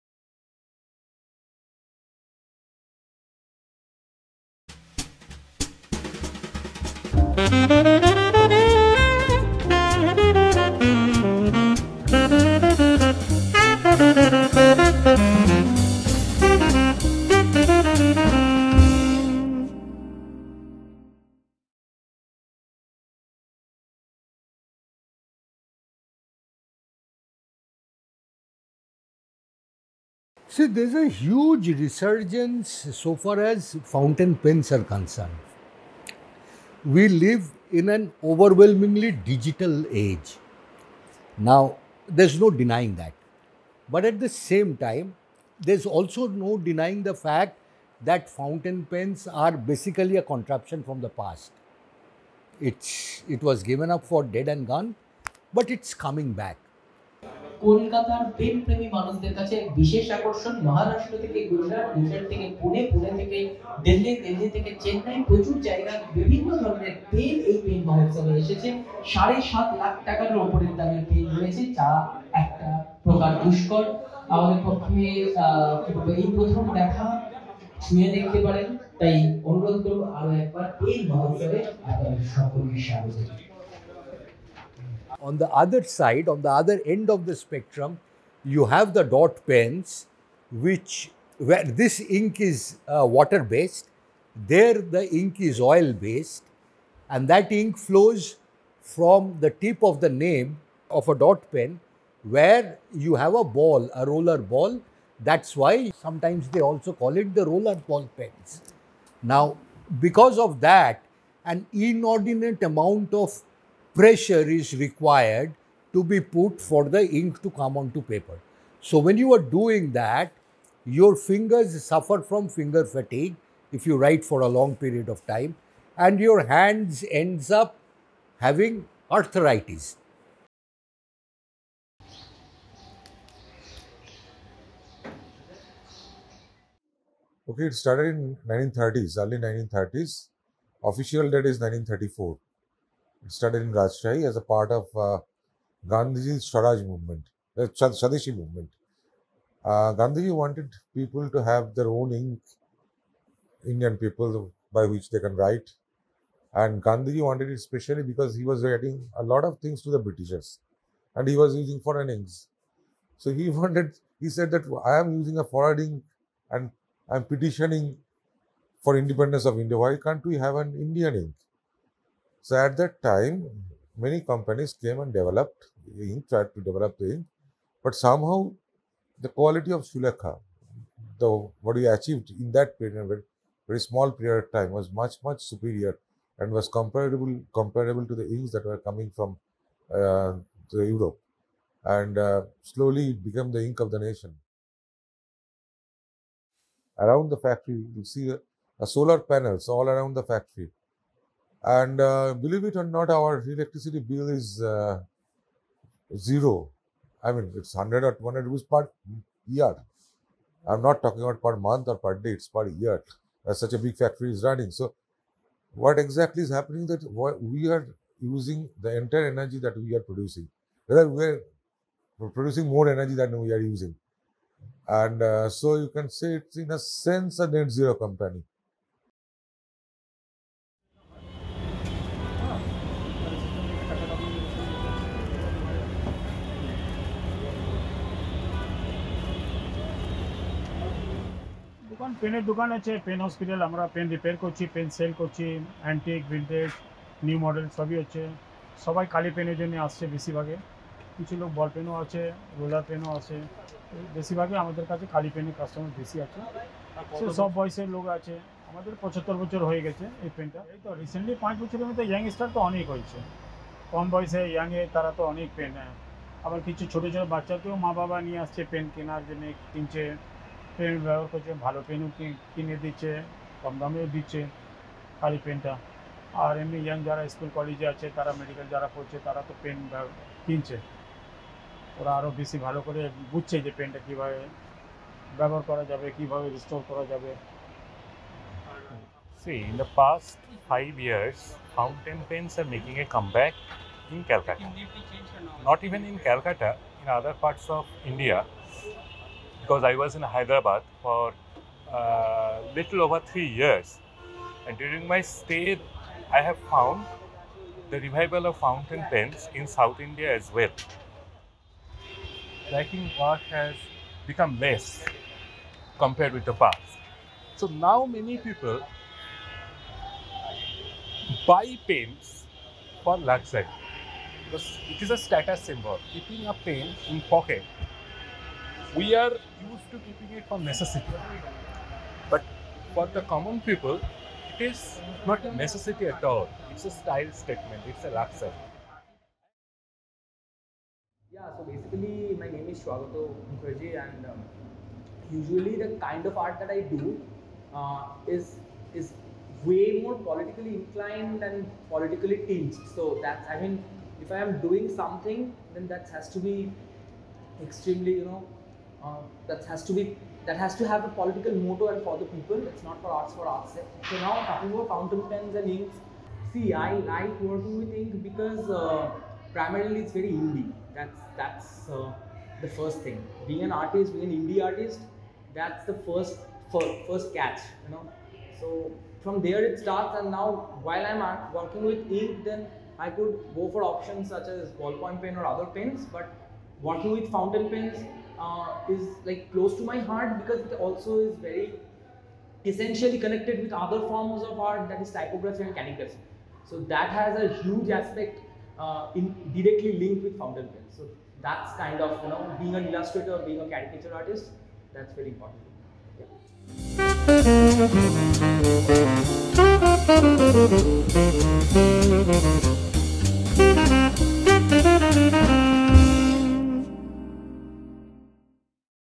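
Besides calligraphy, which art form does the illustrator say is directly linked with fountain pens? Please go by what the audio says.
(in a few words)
Typography.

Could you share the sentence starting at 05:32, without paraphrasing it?
But for the common people, it is not a necessity at all.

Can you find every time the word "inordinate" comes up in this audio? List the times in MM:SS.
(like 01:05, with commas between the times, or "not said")
01:51.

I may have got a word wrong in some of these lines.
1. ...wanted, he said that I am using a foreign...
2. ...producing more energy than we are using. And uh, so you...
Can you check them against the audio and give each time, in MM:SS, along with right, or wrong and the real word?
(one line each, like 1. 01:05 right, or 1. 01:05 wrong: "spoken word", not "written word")
1. 02:43 right
2. 03:42 right.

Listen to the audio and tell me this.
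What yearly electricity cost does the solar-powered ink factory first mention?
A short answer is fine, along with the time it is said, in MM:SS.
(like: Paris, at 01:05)
100 rupees, at 03:27.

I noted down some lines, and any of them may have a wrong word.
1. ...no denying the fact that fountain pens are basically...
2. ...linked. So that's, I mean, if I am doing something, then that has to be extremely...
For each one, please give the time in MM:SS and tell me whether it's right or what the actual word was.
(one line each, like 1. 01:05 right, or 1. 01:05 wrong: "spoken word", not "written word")
1. 00:46 right
2. 05:52 wrong: "tinged", not "linked".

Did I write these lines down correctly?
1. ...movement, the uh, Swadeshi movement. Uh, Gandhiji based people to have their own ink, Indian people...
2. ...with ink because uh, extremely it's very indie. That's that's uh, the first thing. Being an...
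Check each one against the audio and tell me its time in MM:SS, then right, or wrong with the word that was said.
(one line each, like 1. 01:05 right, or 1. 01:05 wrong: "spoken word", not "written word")
1. 02:26 wrong: "wanted", not "based"
2. 06:07 wrong: "primarily", not "extremely".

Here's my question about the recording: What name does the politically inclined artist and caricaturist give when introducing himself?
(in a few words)
Swagato Mukherjee.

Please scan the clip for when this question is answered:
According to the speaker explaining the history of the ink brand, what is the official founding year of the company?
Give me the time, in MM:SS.
02:21.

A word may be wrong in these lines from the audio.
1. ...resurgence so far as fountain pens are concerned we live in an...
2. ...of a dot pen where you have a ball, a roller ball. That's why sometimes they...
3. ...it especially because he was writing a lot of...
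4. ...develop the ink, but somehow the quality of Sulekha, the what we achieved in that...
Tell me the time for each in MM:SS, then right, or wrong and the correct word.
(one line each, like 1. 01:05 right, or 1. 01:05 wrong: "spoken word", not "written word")
1. 00:31 right
2. 01:40 right
3. 02:37 right
4. 02:56 right.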